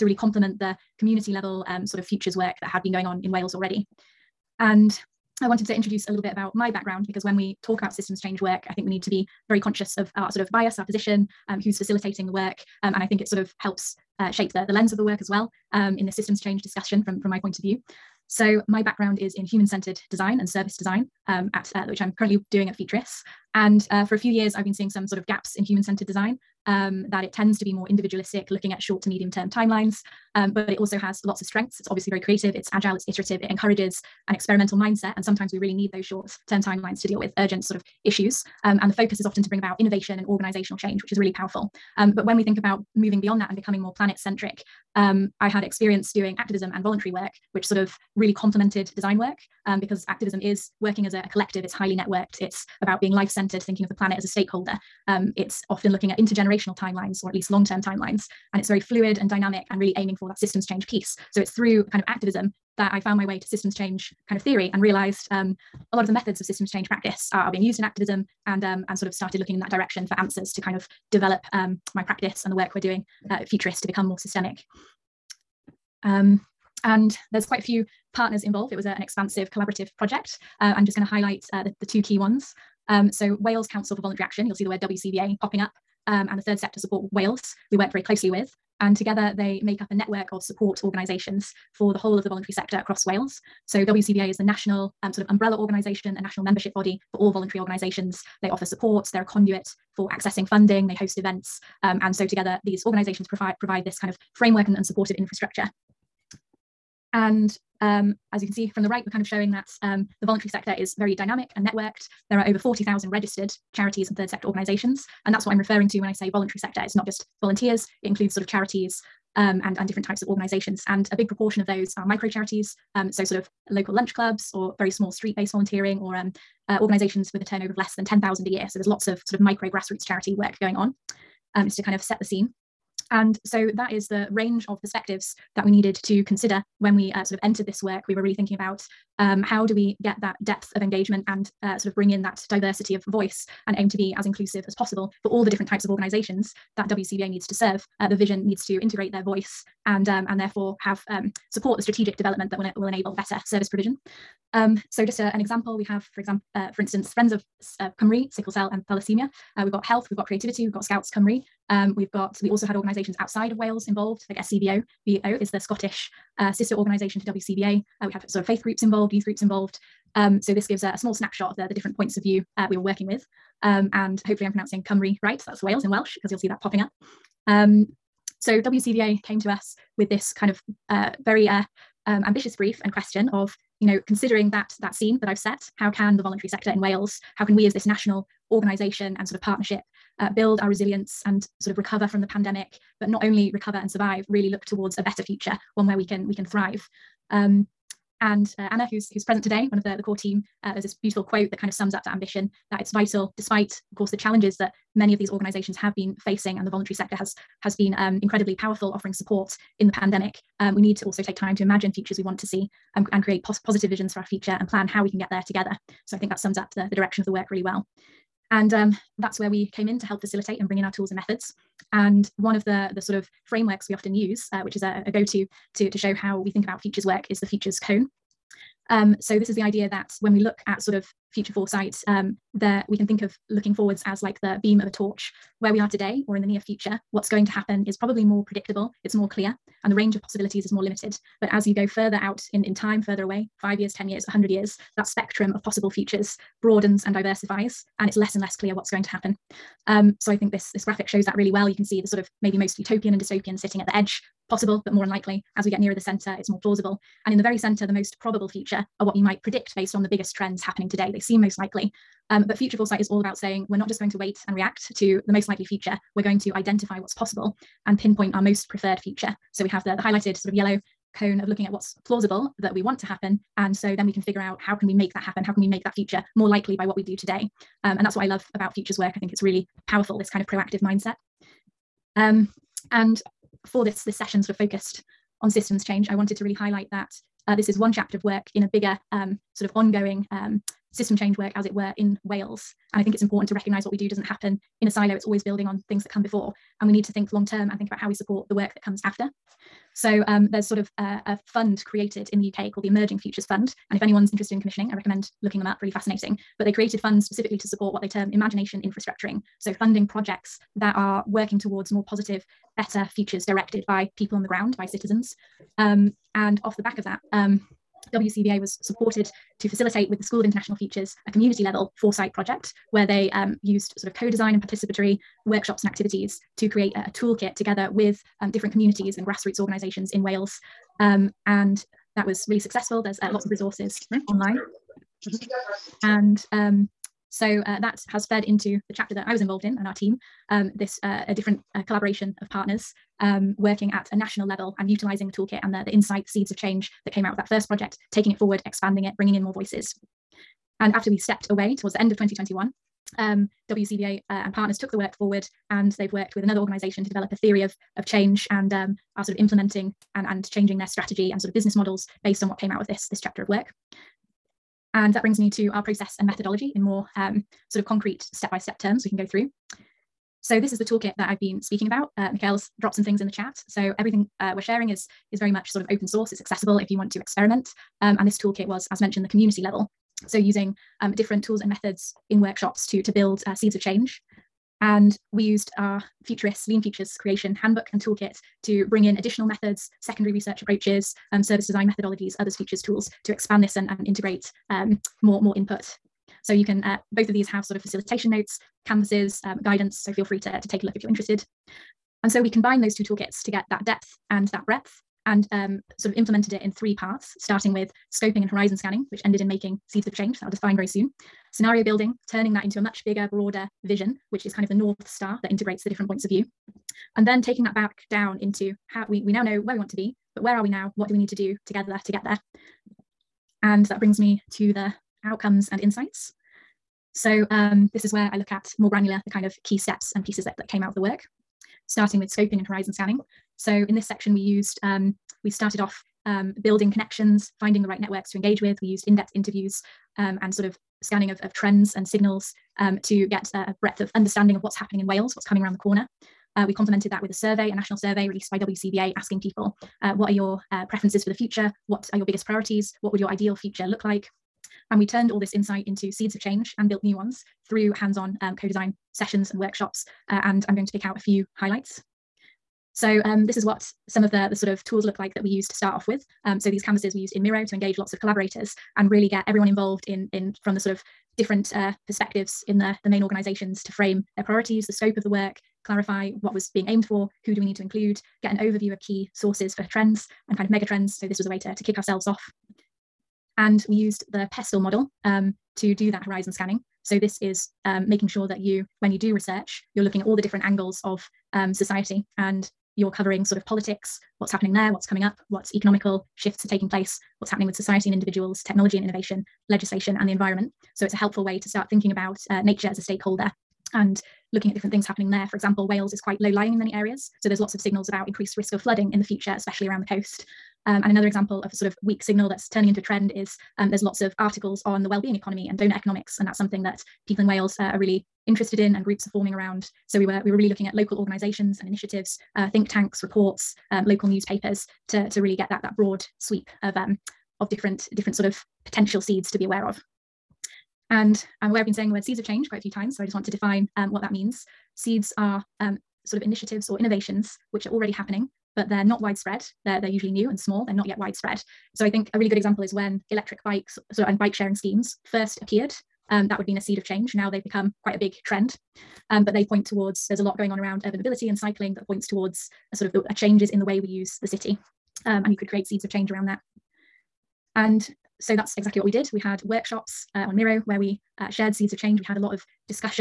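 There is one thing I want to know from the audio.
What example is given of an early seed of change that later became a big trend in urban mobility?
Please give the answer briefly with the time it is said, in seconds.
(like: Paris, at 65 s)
Electric bikes, at 543 s.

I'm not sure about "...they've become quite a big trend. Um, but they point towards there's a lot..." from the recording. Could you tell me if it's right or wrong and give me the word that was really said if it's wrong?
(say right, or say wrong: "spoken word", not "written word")
right.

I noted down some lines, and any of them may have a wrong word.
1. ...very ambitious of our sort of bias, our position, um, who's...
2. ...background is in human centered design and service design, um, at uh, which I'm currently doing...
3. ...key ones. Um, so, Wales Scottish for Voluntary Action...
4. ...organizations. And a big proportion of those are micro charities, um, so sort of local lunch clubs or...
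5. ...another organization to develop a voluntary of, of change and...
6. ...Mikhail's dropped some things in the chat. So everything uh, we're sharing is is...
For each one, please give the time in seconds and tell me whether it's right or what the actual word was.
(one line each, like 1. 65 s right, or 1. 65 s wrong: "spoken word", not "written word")
1. 9 s wrong: "conscious", not "ambitious"
2. 18 s right
3. 82 s wrong: "Council", not "Scottish"
4. 120 s right
5. 356 s wrong: "theory", not "voluntary"
6. 372 s right.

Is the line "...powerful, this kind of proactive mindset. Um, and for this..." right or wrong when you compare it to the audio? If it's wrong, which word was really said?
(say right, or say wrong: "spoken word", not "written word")
right.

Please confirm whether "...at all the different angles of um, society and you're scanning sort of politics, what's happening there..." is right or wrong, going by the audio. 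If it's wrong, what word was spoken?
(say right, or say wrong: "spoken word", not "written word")
wrong: "covering", not "scanning".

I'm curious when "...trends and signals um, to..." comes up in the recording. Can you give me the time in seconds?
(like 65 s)
441 s.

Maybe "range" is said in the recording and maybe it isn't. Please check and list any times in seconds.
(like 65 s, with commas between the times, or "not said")
134 s, 239 s.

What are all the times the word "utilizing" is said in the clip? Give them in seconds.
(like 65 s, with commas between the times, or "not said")
344 s.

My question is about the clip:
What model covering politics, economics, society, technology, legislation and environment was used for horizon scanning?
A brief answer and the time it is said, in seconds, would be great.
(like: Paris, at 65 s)
PESTEL, at 484 s.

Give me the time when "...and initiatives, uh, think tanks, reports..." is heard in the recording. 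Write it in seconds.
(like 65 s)
521 s.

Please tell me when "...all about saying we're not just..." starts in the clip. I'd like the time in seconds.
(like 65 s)
263 s.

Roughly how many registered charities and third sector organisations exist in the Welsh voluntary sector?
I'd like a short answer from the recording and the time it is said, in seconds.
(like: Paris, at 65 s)
Over 40,000, at 112 s.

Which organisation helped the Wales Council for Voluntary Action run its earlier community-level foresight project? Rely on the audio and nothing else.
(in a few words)
School of International Futures.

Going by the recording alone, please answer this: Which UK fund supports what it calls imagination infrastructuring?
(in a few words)
Emerging Futures Fund.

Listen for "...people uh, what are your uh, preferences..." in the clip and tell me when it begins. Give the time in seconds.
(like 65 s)
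449 s.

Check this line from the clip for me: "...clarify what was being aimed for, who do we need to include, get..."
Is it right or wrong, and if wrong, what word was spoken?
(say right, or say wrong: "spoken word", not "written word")
right.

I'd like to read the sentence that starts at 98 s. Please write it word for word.
They offer support, they're a conduit for accessing funding, they host events.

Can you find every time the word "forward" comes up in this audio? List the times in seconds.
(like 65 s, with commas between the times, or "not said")
233 s, 348 s, 355 s.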